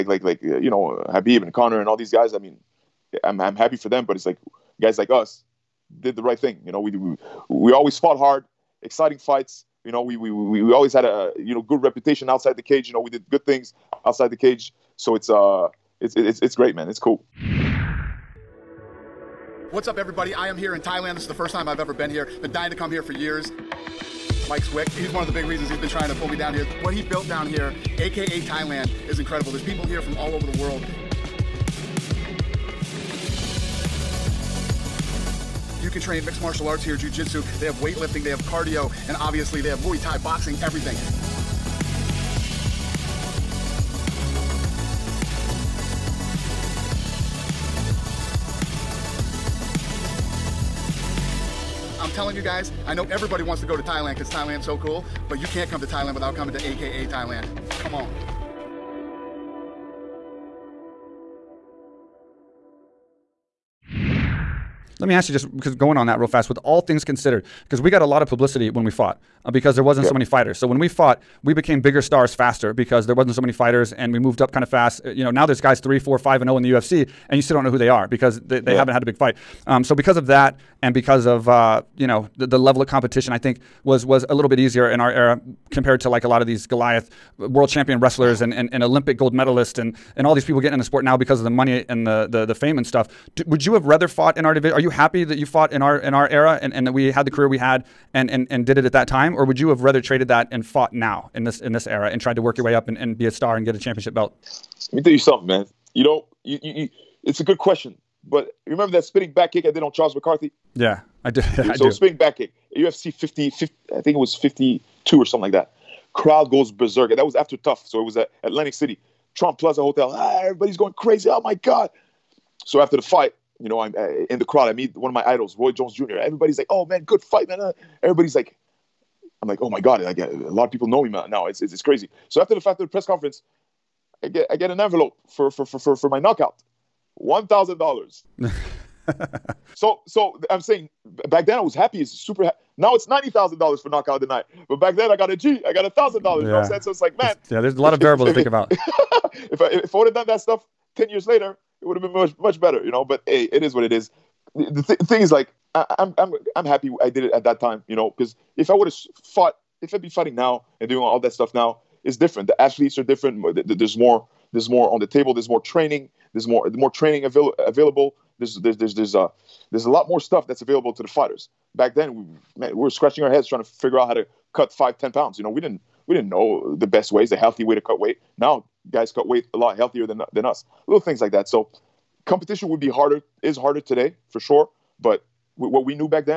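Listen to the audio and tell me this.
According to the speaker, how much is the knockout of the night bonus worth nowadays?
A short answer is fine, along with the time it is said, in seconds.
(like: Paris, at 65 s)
$90,000, at 143 s.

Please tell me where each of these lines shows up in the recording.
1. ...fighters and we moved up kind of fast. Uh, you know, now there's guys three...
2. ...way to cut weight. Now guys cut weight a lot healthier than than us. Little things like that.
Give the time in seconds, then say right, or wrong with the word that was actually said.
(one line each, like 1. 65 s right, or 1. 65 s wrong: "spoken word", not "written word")
1. 73 s right
2. 177 s right.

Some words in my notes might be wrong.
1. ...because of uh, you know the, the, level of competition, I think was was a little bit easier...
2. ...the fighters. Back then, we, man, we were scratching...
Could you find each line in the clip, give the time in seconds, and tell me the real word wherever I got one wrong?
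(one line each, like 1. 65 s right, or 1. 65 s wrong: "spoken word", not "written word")
1. 80 s right
2. 171 s right.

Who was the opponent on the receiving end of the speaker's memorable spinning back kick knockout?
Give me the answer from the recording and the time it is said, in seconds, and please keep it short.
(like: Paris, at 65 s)
Charles McCarthy, at 109 s.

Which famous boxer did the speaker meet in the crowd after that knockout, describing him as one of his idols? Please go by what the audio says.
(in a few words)
Roy Jones Jr.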